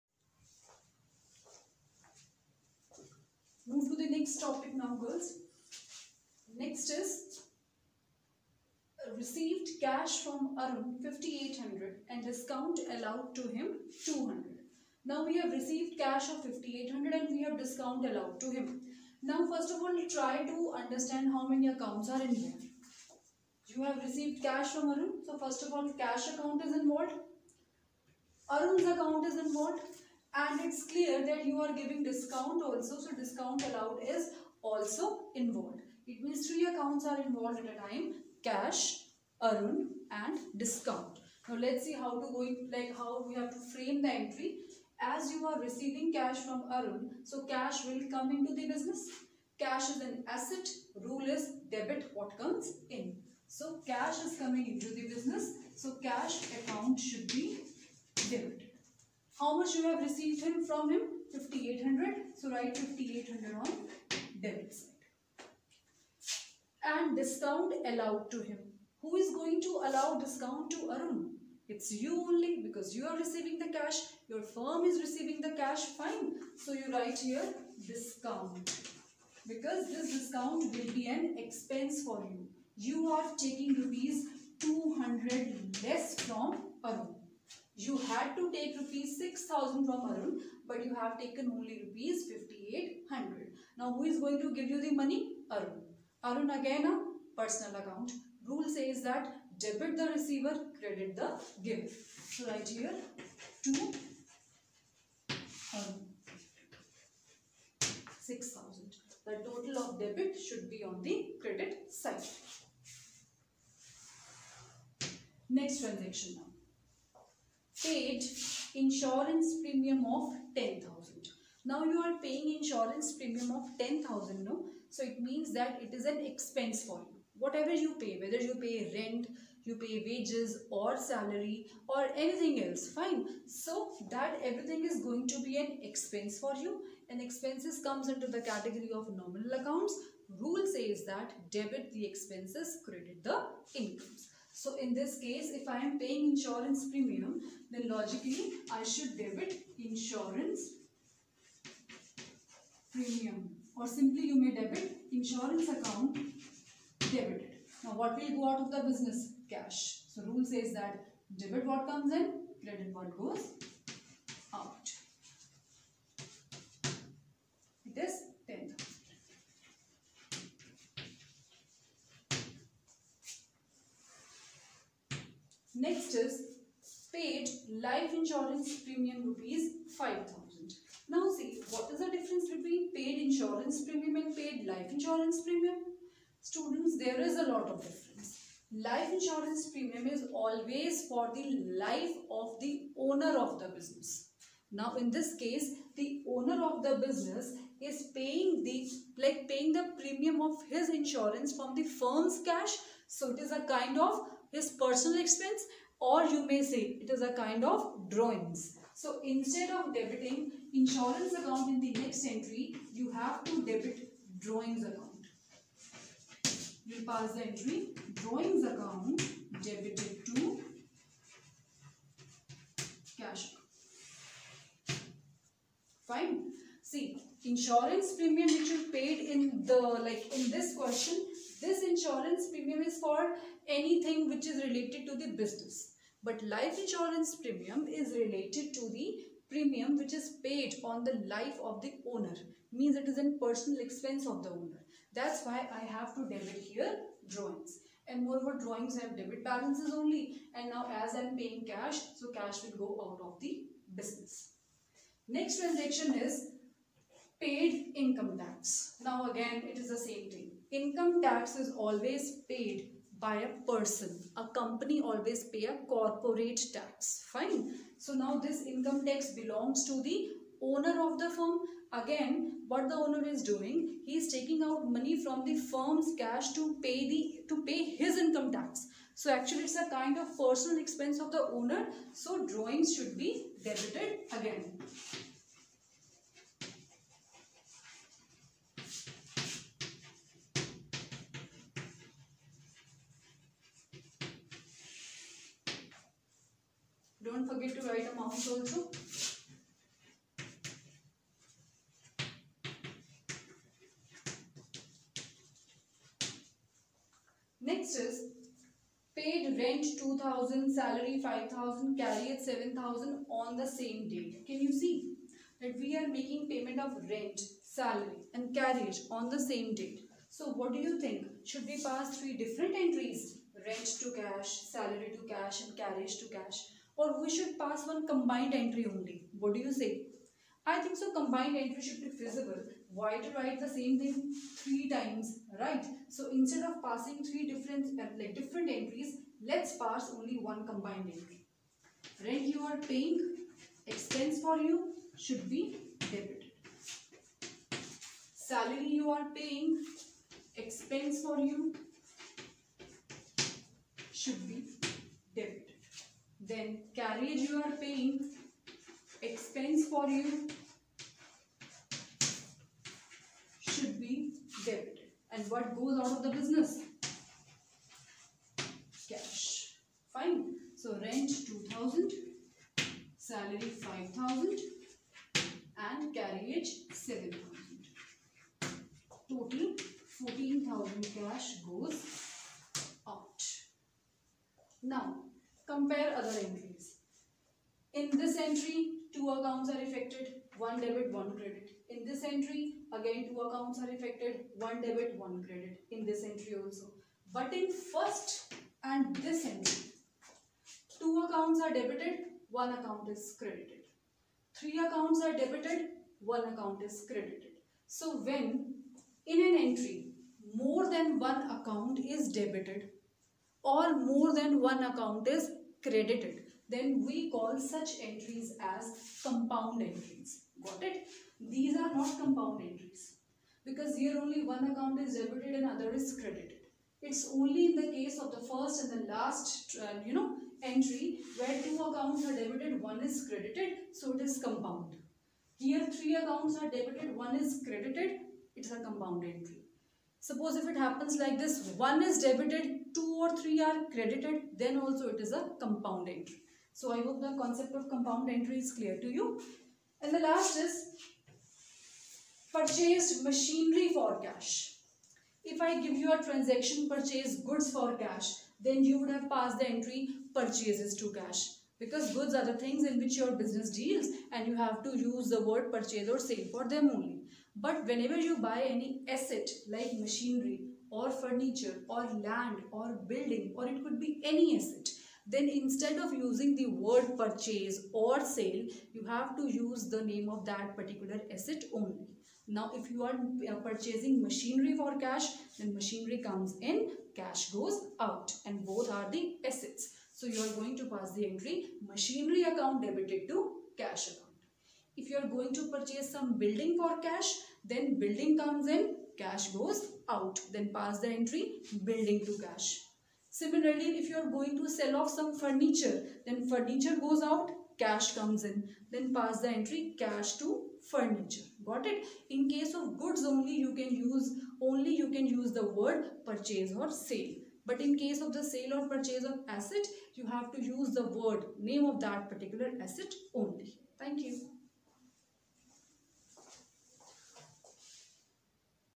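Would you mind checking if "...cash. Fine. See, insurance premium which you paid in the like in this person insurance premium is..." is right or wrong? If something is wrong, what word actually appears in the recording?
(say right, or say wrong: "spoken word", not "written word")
wrong: "question", not "person".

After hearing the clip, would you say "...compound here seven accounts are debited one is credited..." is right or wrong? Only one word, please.
wrong.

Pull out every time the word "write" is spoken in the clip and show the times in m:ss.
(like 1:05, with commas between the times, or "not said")
1:02, 1:16, 4:57, 5:33.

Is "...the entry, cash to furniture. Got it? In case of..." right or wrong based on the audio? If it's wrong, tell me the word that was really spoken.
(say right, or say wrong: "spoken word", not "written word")
right.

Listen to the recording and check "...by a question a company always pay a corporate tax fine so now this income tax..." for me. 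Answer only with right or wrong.
wrong.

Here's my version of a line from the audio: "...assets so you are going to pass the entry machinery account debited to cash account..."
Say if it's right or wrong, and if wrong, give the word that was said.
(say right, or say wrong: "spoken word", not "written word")
right.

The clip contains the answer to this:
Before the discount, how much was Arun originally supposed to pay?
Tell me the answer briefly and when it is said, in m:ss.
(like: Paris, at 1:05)
6000, at 1:28.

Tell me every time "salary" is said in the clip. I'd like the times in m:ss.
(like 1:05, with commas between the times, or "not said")
2:10, 5:10, 5:17, 5:24, 5:48, 6:13.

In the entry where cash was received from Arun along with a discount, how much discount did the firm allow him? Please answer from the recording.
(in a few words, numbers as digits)
200.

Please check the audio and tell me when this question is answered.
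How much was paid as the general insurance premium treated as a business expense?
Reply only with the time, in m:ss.
1:57.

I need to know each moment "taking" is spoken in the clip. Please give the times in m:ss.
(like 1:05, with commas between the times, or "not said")
1:23, 4:34.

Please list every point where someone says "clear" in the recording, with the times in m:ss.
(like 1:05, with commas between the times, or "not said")
0:30, 7:28.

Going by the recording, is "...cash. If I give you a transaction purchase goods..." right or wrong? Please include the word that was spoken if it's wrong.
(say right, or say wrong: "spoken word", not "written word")
right.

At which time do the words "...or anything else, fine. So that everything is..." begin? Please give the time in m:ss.
2:11.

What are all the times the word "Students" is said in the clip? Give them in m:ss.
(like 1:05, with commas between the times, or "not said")
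3:06.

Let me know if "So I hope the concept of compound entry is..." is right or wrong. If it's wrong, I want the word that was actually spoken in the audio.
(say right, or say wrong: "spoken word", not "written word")
right.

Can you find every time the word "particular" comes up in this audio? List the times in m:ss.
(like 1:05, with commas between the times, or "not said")
8:00, 8:42.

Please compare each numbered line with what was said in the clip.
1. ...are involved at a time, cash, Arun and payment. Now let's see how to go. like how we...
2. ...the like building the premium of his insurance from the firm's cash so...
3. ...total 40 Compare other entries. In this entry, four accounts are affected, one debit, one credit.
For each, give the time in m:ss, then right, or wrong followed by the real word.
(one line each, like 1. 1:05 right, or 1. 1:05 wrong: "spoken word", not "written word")
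1. 0:37 wrong: "discount", not "payment"
2. 3:18 wrong: "paying", not "building"
3. 6:19 wrong: "two", not "four".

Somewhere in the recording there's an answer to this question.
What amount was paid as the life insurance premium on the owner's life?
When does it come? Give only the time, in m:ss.
2:57.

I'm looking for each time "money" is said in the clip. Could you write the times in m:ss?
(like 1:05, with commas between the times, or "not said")
1:34, 4:34.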